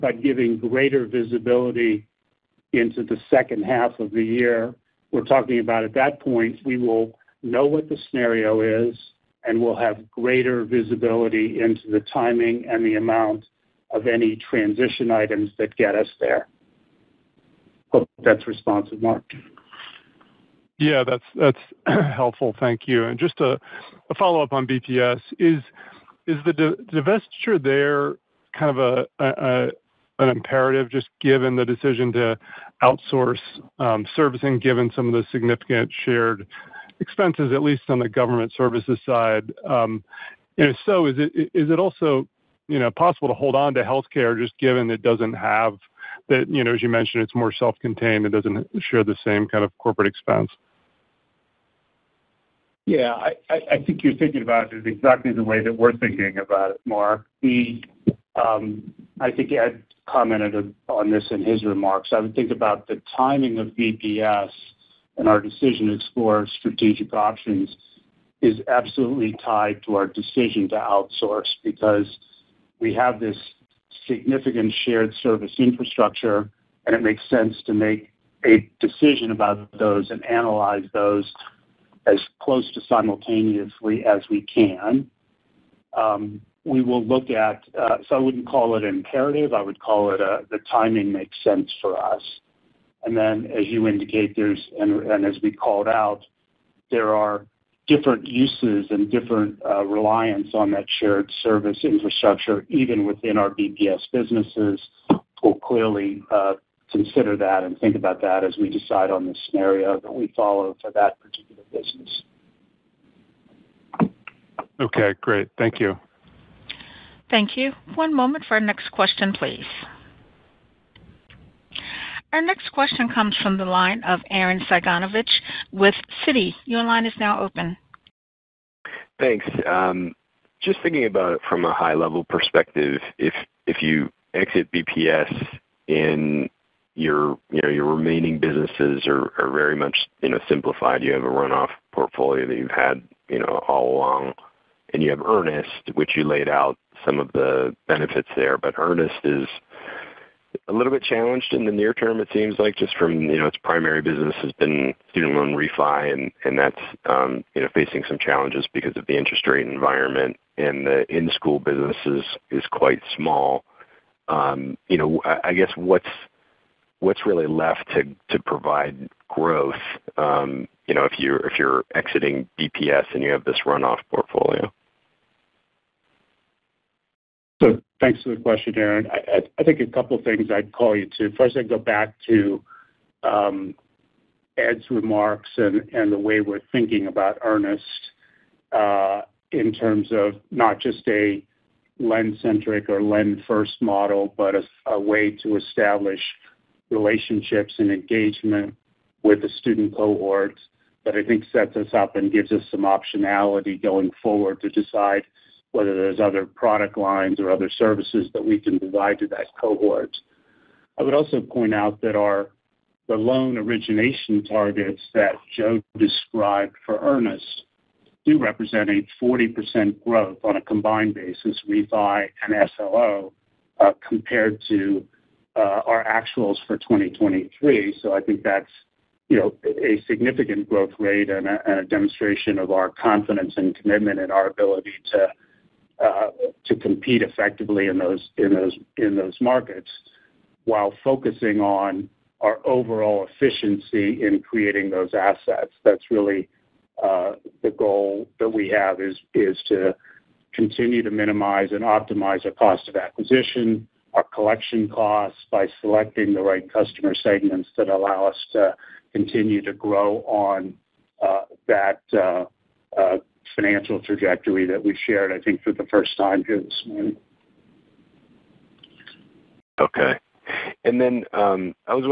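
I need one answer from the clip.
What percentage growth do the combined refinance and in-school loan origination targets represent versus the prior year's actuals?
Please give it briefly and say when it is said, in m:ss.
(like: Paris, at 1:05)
40%, at 3:39.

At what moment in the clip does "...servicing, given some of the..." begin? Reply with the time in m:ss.
0:34.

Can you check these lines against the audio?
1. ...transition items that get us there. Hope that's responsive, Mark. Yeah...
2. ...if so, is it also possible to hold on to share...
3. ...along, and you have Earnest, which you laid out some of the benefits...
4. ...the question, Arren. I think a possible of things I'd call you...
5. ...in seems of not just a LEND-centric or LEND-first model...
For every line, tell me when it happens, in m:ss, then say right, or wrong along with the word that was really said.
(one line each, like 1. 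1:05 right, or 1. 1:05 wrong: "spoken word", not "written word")
1. 0:14 right
2. 0:40 wrong: "healthcare", not "share"
3. 2:23 right
4. 2:58 wrong: "couple", not "possible"
5. 3:09 wrong: "terms", not "seems".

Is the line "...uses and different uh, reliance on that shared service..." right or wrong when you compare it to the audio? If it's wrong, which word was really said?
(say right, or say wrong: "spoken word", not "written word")
right.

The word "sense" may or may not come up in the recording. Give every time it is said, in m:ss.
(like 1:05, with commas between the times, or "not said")
1:17, 1:31.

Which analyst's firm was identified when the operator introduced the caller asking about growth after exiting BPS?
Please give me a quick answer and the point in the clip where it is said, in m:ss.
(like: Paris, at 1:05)
Citi, at 2:06.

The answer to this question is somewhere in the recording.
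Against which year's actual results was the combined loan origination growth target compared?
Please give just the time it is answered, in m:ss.
3:46.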